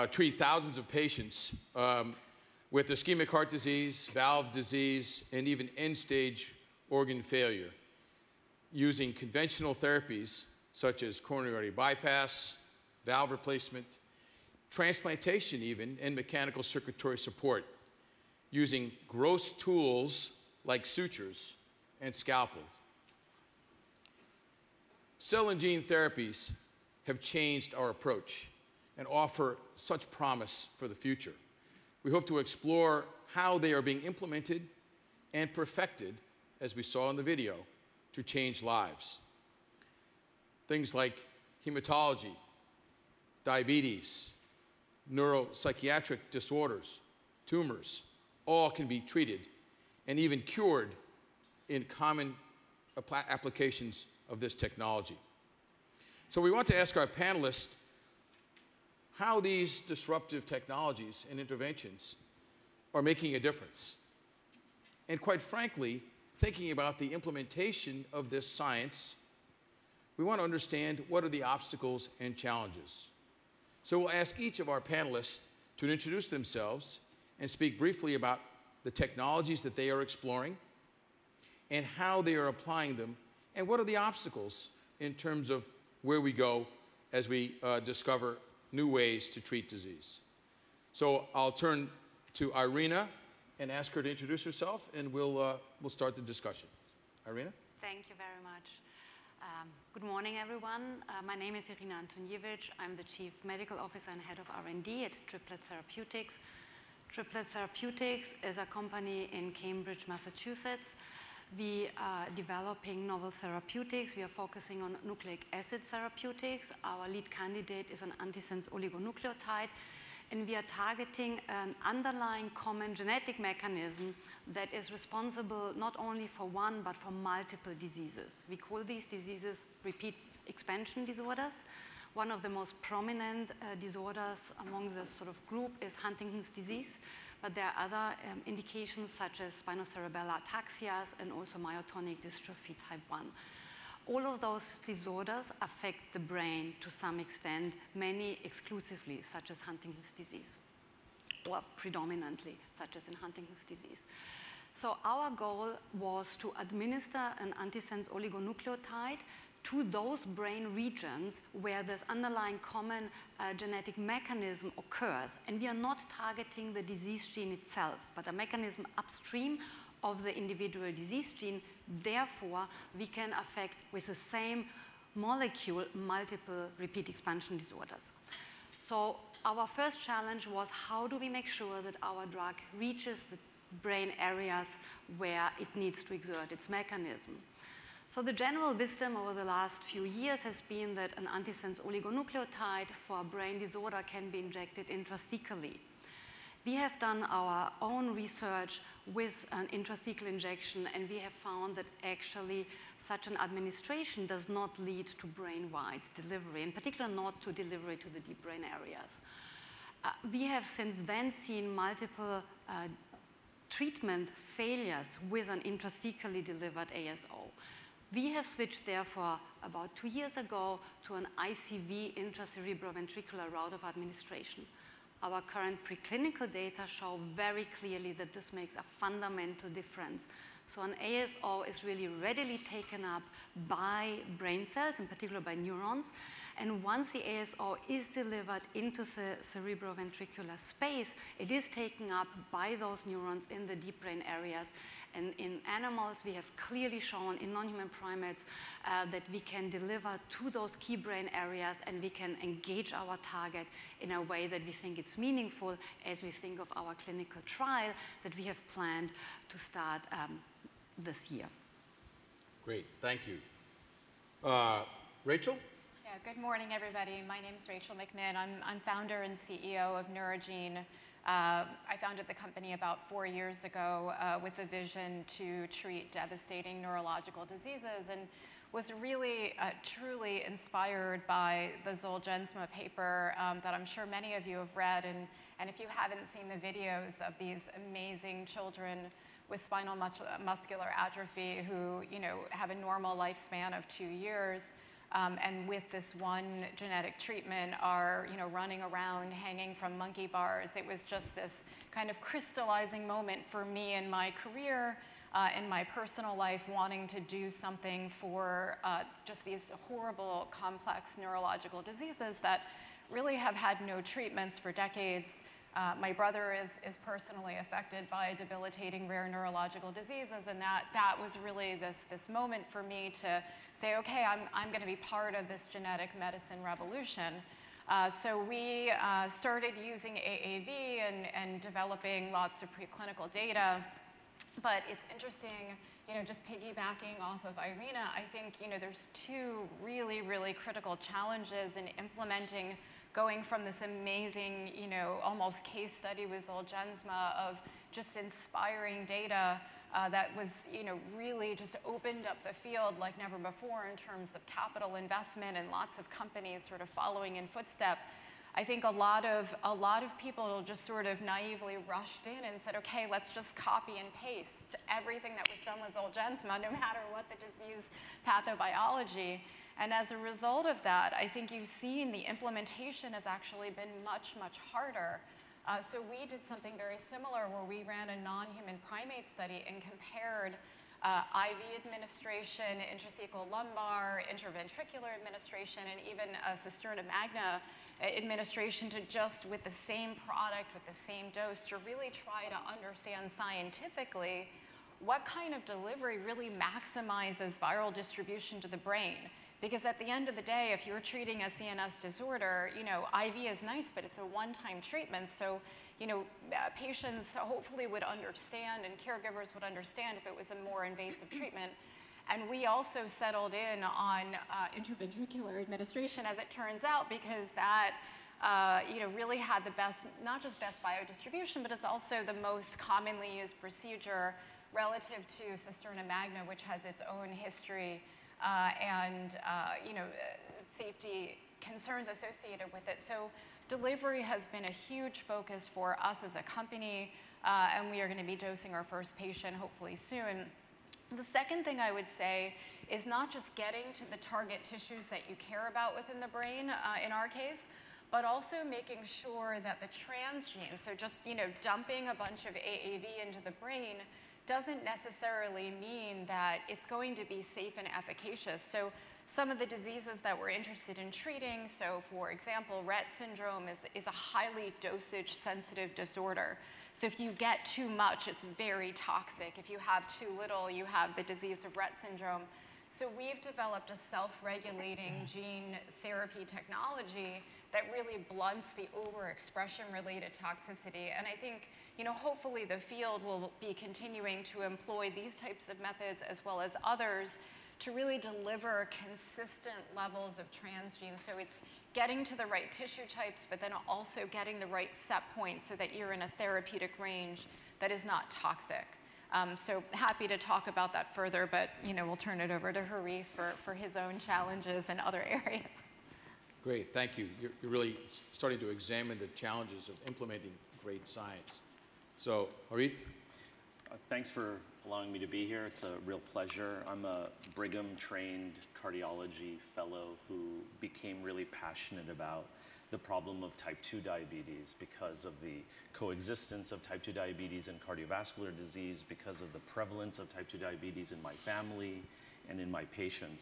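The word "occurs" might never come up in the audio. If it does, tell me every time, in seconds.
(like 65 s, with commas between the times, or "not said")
164 s.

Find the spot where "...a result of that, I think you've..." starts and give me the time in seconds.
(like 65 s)
370 s.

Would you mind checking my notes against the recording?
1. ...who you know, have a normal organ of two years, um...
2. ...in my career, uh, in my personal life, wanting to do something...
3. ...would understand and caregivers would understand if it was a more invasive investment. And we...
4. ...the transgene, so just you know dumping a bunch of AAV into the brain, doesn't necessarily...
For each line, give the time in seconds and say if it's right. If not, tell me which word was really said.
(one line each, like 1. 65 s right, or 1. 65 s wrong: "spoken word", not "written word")
1. 291 s wrong: "lifespan", not "organ"
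2. 303 s right
3. 407 s wrong: "treatment", not "investment"
4. 449 s right.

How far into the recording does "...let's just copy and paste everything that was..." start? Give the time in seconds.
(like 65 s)
363 s.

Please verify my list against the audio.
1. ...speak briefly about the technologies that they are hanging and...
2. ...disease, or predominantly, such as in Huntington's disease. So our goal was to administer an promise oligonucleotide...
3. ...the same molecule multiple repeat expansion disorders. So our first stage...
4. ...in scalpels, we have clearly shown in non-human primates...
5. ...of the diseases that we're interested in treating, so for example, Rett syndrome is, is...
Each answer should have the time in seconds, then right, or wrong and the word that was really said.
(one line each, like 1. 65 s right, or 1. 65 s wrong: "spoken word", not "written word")
1. 77 s wrong: "exploring", not "hanging"
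2. 150 s wrong: "antisense", not "promise"
3. 174 s wrong: "challenge", not "stage"
4. 245 s wrong: "animals", not "scalpels"
5. 459 s right.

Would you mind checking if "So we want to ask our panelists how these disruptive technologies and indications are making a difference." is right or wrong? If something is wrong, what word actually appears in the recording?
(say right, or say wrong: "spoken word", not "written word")
wrong: "interventions", not "indications".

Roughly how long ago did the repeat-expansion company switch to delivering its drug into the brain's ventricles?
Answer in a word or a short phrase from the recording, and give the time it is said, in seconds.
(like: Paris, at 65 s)
2 years ago, at 219 s.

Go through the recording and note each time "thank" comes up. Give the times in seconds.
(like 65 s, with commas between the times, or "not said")
97 s, 262 s, 506 s, 514 s.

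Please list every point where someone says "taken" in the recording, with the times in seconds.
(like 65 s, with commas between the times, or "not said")
232 s, 241 s.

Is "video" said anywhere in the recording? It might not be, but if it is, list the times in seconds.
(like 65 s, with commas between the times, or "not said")
37 s, 286 s.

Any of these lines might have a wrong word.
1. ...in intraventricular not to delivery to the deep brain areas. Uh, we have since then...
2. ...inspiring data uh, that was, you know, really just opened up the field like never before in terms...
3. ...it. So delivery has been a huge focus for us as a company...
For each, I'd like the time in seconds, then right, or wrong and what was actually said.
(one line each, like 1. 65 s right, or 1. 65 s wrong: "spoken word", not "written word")
1. 206 s wrong: "particular", not "intraventricular"
2. 348 s right
3. 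432 s right.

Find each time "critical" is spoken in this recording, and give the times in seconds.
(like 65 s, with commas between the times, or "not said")
340 s.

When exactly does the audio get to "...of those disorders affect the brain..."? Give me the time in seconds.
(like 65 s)
144 s.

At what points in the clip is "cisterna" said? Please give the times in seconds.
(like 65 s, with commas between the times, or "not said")
386 s, 425 s.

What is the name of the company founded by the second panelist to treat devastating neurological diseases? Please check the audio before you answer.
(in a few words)
Neurogene.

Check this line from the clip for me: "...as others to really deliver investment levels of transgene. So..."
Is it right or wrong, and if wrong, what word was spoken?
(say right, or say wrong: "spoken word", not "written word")
wrong: "consistent", not "investment".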